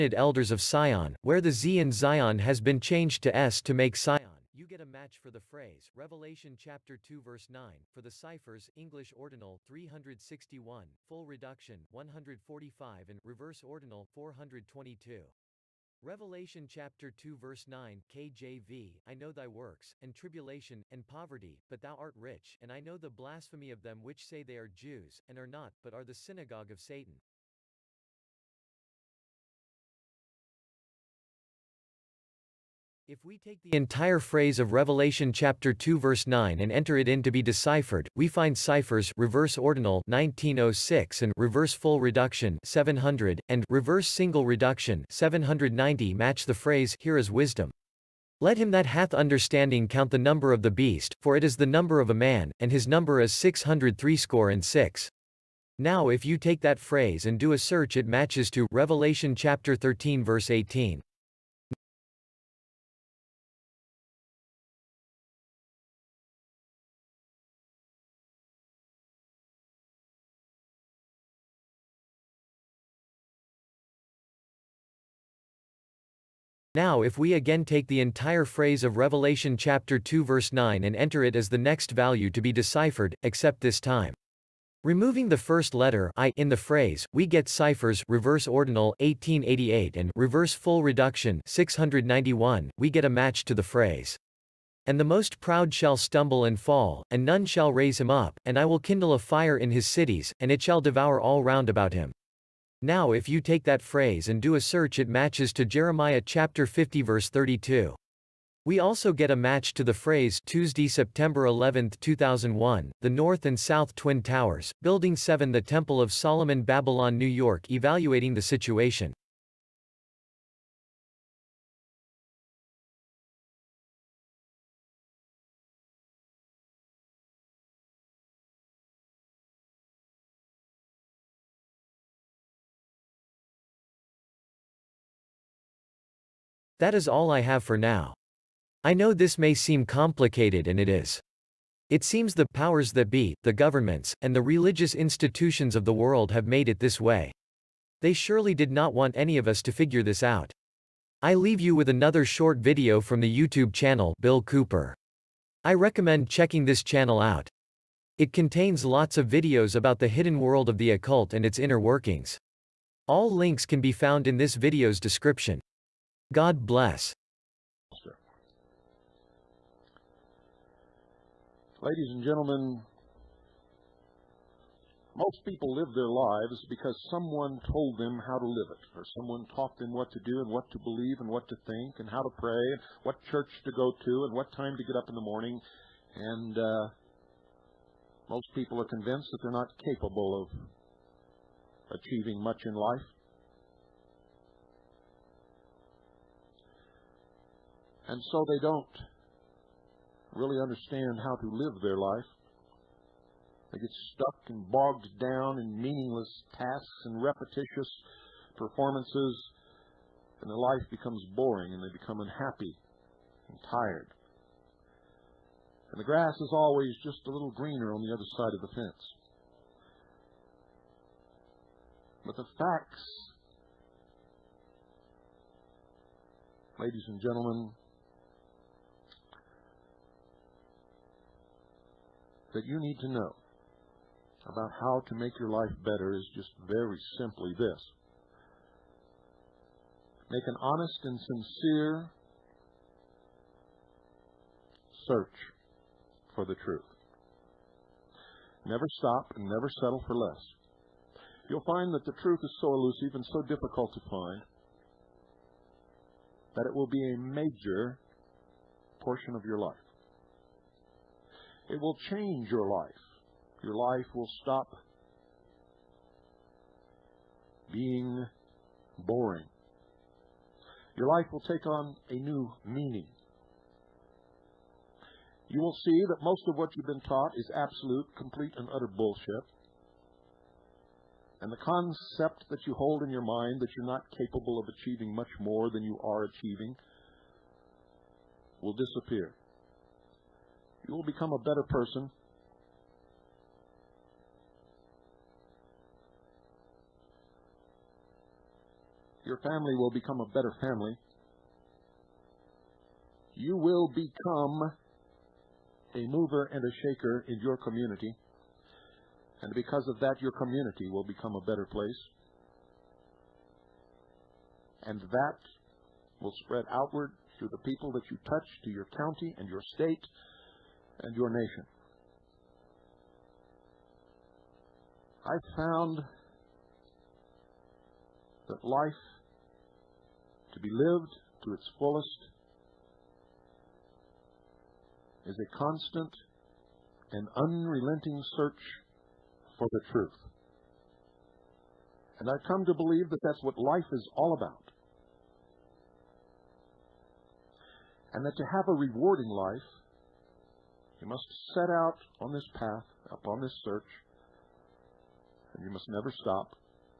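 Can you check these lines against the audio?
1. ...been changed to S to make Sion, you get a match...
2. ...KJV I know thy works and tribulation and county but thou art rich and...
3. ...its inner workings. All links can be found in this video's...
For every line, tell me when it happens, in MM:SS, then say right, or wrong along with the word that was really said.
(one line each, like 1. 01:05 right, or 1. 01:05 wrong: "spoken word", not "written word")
1. 00:02 right
2. 00:18 wrong: "poverty", not "county"
3. 02:41 right.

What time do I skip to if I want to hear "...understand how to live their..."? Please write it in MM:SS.
03:20.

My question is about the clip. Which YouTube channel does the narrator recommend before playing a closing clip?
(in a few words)
Bill Cooper.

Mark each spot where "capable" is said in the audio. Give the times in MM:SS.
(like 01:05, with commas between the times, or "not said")
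03:09, 04:44.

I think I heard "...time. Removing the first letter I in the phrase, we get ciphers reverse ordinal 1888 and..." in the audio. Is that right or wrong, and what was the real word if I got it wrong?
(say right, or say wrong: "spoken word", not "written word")
right.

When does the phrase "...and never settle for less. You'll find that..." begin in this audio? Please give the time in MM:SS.
04:09.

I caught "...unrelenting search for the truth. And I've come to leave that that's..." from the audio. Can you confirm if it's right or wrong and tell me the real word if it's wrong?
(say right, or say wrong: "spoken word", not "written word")
wrong: "believe", not "leave".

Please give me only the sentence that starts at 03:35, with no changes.
And the grass is always just a little greener on the other side of the fence.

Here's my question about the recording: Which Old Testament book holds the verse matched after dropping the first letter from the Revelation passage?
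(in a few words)
Jeremiah.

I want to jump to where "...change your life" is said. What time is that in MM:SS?
04:22.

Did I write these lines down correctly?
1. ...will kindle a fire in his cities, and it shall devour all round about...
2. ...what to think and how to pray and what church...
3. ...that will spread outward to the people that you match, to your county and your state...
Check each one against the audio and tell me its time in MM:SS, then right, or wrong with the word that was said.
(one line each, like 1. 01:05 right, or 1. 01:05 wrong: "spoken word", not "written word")
1. 01:38 right
2. 03:01 right
3. 05:15 wrong: "touch", not "match".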